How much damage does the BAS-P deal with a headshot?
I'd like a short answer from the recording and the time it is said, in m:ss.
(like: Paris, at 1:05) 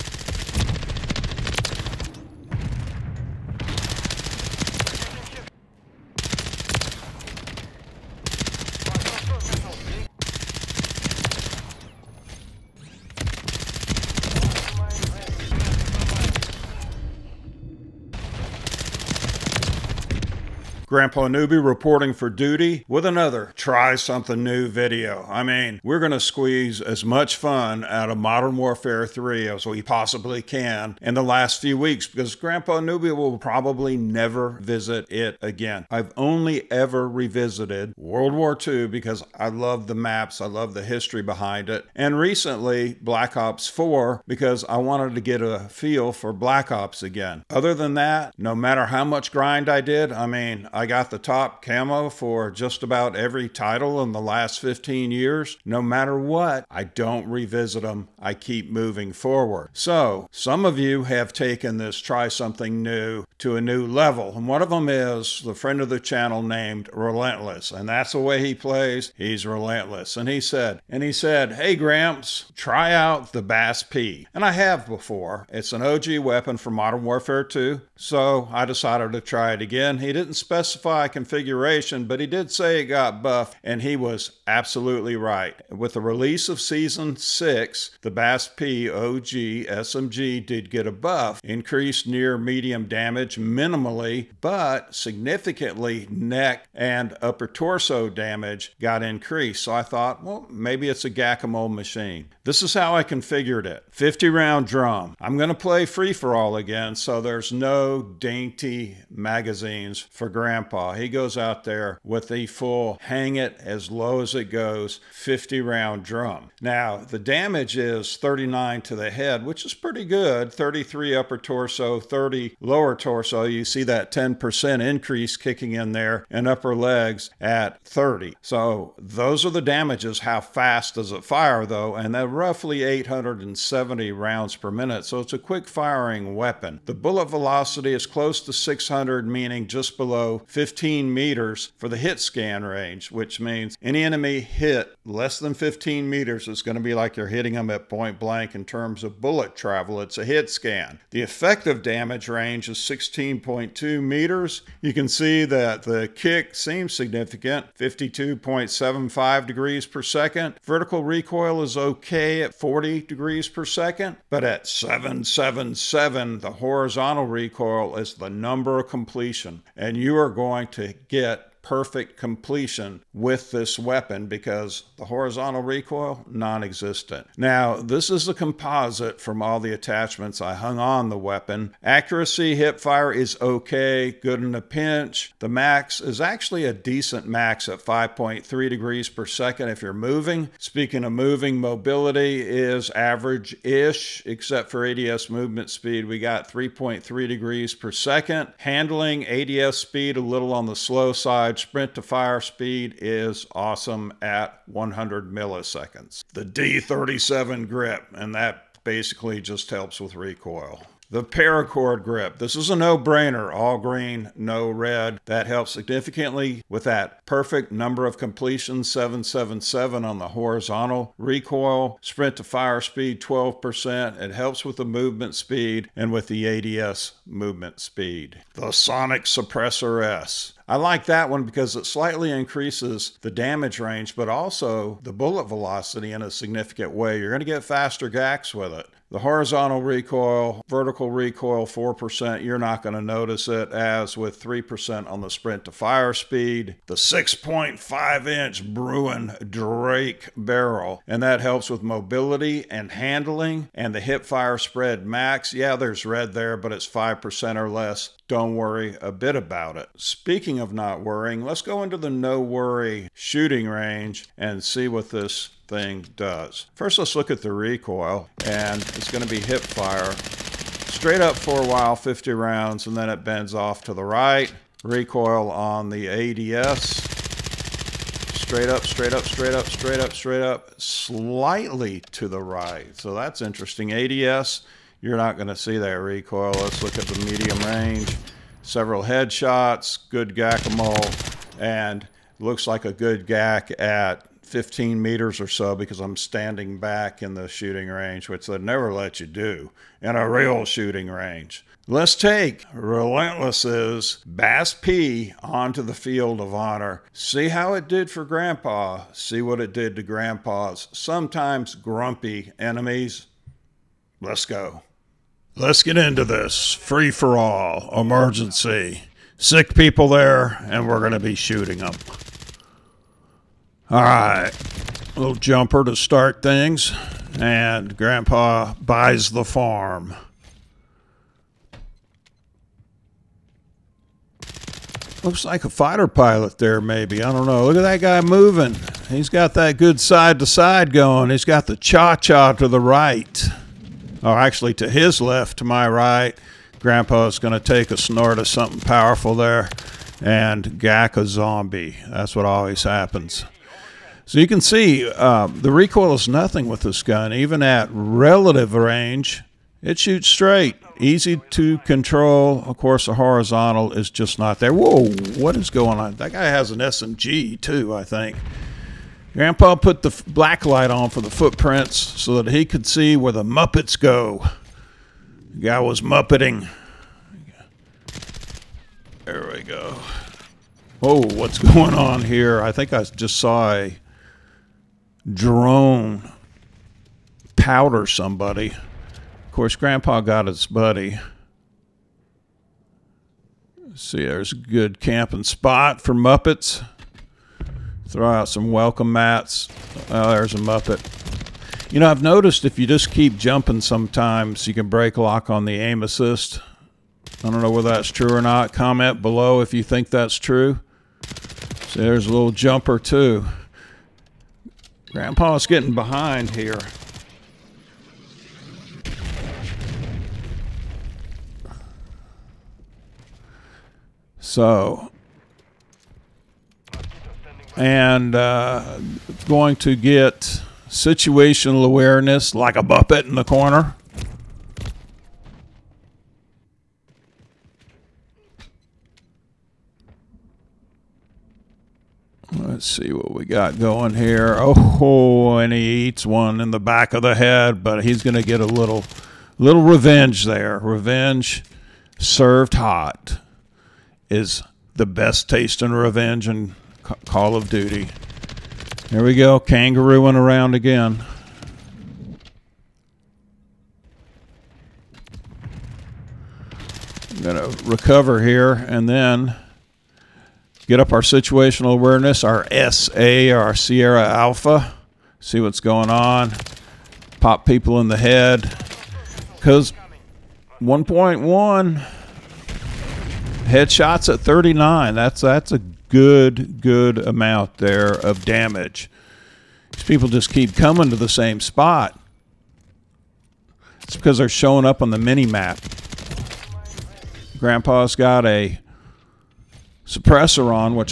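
39, at 1:58.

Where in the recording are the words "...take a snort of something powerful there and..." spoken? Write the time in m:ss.
5:47.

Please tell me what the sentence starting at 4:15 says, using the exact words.
Yeah, there's red there, but it's 5% or less.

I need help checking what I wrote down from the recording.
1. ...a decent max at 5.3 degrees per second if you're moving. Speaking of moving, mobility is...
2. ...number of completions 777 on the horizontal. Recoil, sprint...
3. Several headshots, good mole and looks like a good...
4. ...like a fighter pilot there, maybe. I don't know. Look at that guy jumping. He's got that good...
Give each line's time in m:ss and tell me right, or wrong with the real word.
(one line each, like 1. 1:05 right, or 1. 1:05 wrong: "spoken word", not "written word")
1. 3:06 right
2. 3:37 right
3. 4:48 right
4. 5:35 wrong: "moving", not "jumping".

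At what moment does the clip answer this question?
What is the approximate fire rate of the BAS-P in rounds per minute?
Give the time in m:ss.
2:12.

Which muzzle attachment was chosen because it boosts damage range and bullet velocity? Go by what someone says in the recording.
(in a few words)
Sonic Suppressor S.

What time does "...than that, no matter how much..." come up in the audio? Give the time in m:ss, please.
0:47.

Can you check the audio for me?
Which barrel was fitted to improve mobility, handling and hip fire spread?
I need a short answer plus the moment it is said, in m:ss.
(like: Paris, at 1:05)
6.5 inch Bruin Drake, at 4:06.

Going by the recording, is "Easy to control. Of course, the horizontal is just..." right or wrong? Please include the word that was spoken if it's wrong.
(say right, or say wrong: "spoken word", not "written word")
right.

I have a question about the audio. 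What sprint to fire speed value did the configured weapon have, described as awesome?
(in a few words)
100 milliseconds.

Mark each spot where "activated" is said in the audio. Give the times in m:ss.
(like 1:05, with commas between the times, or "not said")
not said.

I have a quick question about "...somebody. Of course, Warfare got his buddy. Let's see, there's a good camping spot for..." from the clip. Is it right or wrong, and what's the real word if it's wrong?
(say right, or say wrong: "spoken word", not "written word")
wrong: "Grandpa", not "Warfare".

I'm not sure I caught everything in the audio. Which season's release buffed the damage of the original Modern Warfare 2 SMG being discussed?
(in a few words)
Season 6.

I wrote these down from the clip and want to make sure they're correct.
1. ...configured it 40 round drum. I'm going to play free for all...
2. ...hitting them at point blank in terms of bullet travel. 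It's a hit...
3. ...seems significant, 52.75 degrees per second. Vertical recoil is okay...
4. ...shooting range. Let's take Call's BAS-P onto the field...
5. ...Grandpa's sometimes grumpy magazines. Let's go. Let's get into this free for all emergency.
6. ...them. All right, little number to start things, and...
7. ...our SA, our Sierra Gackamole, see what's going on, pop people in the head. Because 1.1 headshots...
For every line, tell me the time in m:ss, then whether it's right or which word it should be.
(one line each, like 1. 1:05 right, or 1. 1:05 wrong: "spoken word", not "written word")
1. 1:43 wrong: "50", not "40"
2. 2:27 right
3. 2:36 right
4. 5:00 wrong: "Relentless", not "Call"
5. 5:10 wrong: "enemies", not "magazines"
6. 5:21 wrong: "jumper", not "number"
7. 7:52 wrong: "Alpha", not "Gackamole".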